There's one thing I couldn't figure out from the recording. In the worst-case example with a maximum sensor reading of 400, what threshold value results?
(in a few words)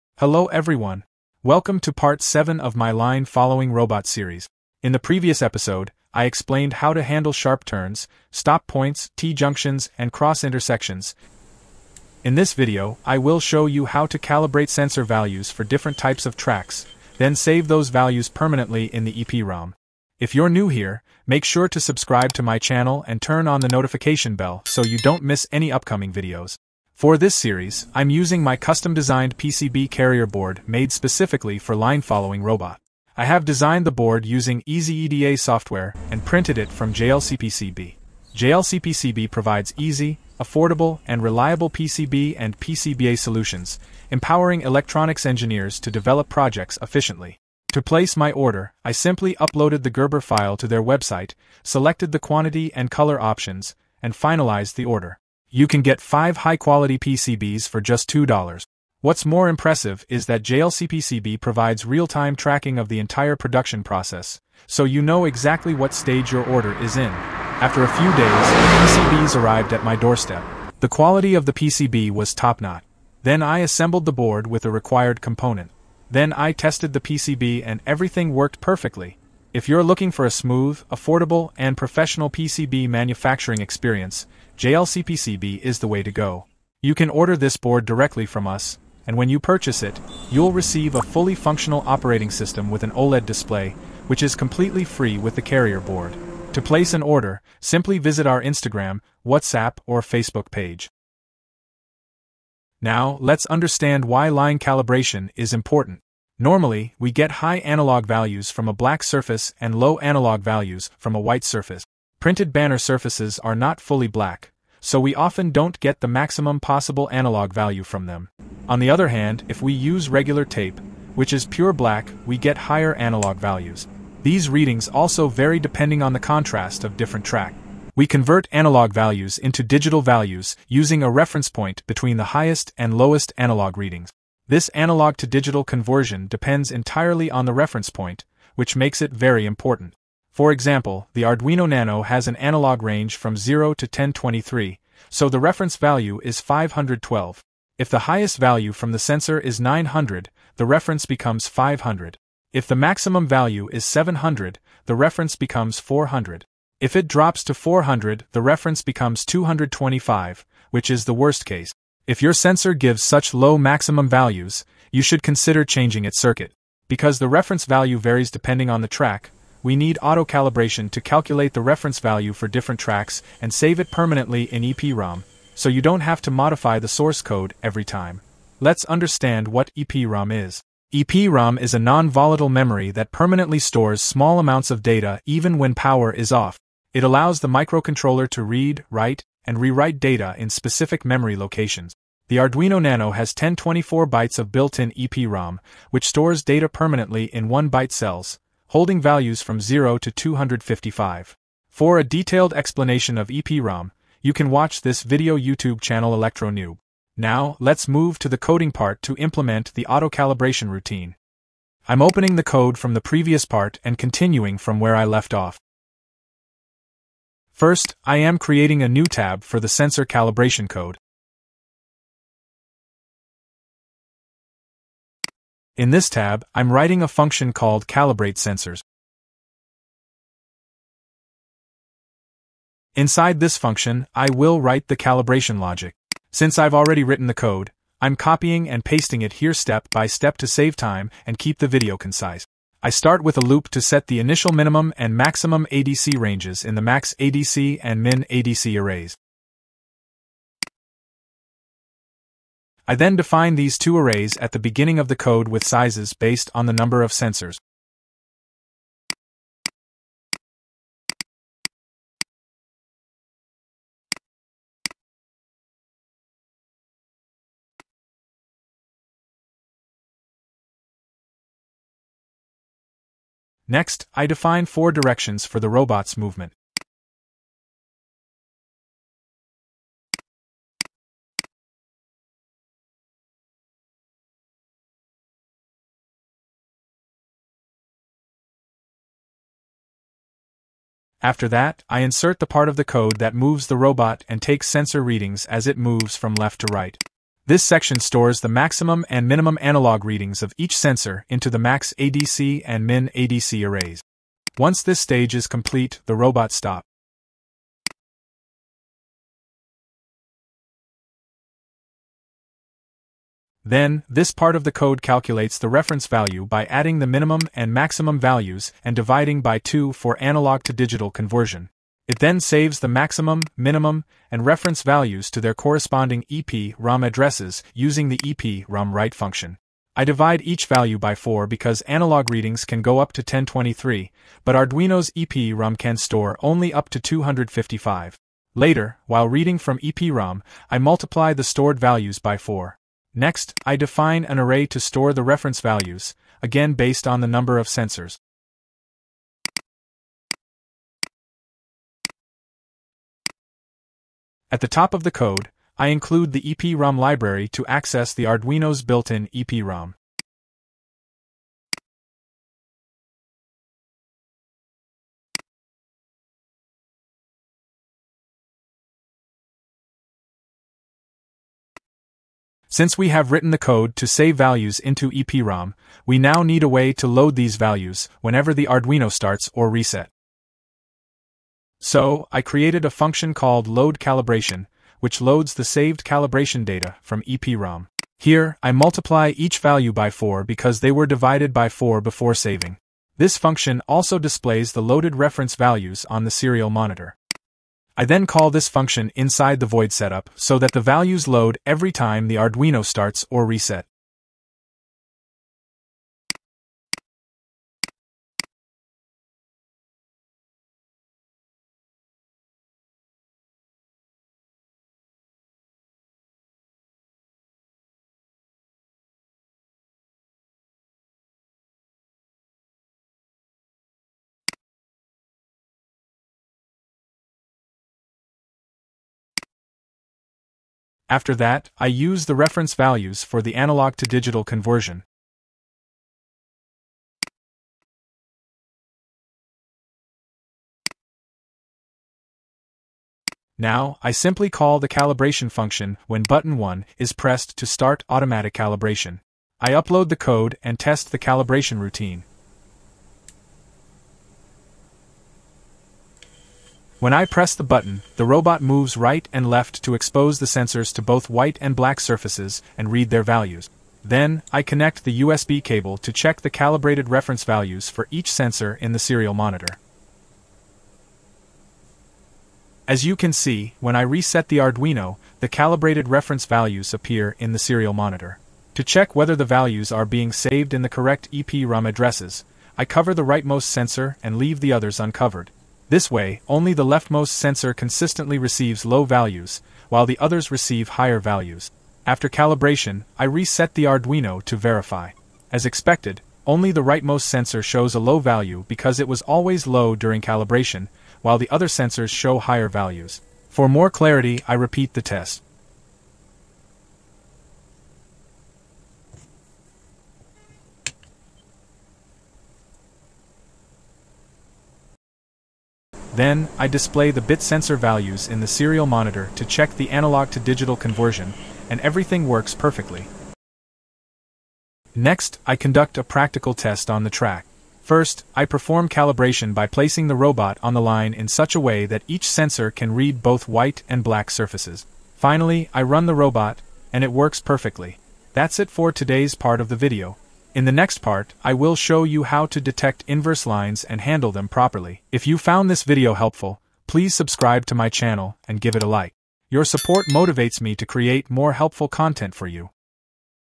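225.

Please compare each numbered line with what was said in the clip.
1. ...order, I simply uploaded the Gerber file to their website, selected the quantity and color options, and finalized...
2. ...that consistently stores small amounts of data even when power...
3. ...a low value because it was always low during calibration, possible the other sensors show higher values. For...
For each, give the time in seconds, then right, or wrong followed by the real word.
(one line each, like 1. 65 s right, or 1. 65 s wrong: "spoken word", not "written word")
1. 48 s right
2. 182 s wrong: "permanently", not "consistently"
3. 497 s wrong: "while", not "possible".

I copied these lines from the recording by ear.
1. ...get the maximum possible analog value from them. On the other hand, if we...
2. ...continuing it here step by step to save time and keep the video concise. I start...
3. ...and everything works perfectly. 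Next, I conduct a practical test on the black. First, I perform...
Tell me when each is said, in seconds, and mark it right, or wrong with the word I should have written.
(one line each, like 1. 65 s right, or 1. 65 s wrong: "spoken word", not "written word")
1. 115 s right
2. 238 s wrong: "pasting", not "continuing"
3. 521 s wrong: "track", not "black".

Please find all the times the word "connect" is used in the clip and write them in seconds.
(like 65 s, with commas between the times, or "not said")
464 s.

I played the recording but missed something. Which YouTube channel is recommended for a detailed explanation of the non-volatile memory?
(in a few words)
ElectroNew.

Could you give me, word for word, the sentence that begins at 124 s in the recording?
These readings also vary depending on the contrast of different track.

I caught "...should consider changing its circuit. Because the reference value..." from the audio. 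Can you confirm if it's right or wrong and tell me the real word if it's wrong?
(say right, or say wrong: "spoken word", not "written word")
right.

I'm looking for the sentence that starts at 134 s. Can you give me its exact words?
This analog to digital conversion depends entirely on the reference point, which makes it very important.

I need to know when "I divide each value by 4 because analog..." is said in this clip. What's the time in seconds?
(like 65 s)
329 s.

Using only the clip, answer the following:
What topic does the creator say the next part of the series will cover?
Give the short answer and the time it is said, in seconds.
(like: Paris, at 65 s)
inverse lines, at 543 s.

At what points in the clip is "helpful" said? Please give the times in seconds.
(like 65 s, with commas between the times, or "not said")
546 s, 551 s.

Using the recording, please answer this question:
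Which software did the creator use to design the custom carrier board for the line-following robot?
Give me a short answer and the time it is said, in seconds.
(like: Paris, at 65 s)
EasyEDA, at 34 s.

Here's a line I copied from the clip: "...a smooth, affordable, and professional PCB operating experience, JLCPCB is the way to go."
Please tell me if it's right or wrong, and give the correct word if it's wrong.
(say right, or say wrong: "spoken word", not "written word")
wrong: "manufacturing", not "operating".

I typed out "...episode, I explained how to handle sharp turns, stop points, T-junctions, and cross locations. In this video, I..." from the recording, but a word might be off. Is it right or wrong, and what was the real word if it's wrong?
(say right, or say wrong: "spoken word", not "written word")
wrong: "intersections", not "locations".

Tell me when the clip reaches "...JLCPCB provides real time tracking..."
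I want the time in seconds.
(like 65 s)
60 s.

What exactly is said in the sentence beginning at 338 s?
Later, while reading from EPROM, I multiply the stored values by 4.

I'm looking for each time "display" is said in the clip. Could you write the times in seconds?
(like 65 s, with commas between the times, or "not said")
93 s, 394 s, 516 s.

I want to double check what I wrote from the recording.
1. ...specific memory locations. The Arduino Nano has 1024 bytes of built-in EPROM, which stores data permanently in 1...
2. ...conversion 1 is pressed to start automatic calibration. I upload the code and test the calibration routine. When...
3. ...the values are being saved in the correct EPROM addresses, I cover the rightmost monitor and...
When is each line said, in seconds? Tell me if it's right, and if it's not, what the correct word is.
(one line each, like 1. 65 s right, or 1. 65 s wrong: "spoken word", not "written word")
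1. 190 s right
2. 446 s wrong: "button", not "conversion"
3. 479 s wrong: "sensor", not "monitor".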